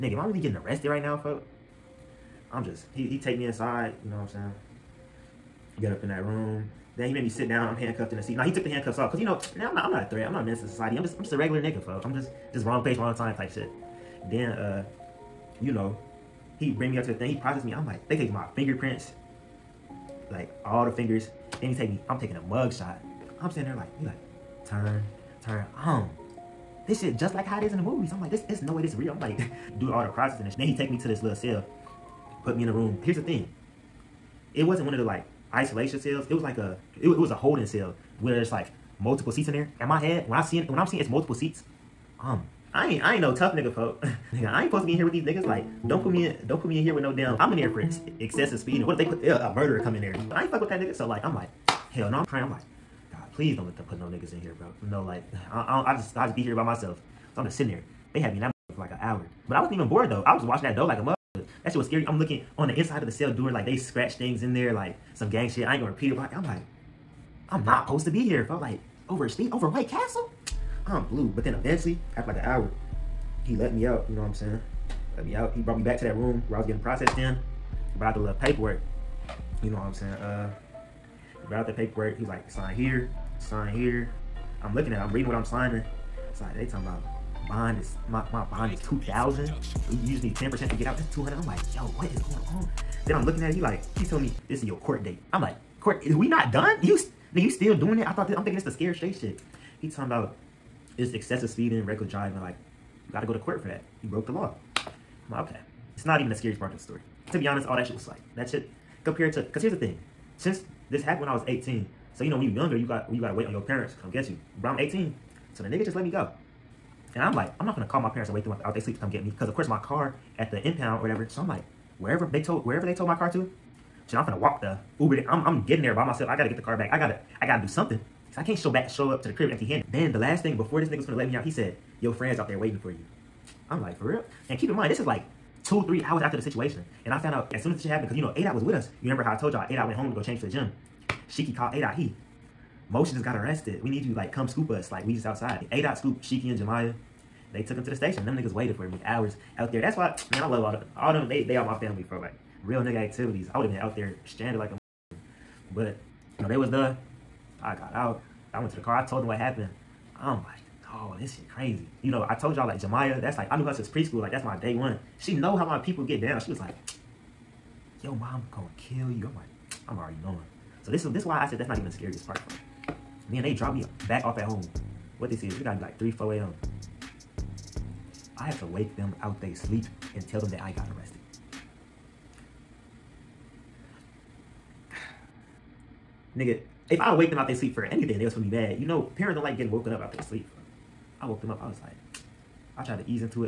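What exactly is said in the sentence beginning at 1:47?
To be honest, all that shit was like, that shit compared to, cause here's the thing.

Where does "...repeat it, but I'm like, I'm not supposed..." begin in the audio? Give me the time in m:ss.
1:05.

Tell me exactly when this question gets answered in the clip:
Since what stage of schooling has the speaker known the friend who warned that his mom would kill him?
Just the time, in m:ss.
2:43.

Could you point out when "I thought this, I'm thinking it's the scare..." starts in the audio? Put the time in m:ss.
1:38.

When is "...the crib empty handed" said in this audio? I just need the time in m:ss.
2:09.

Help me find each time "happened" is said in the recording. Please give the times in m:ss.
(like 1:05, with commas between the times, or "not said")
1:51, 2:17, 2:39.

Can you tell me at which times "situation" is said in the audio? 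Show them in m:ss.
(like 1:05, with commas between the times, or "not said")
2:16.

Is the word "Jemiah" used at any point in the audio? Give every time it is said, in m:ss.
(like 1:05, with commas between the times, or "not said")
2:26, 2:42.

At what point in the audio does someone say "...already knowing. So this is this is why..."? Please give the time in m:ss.
2:49.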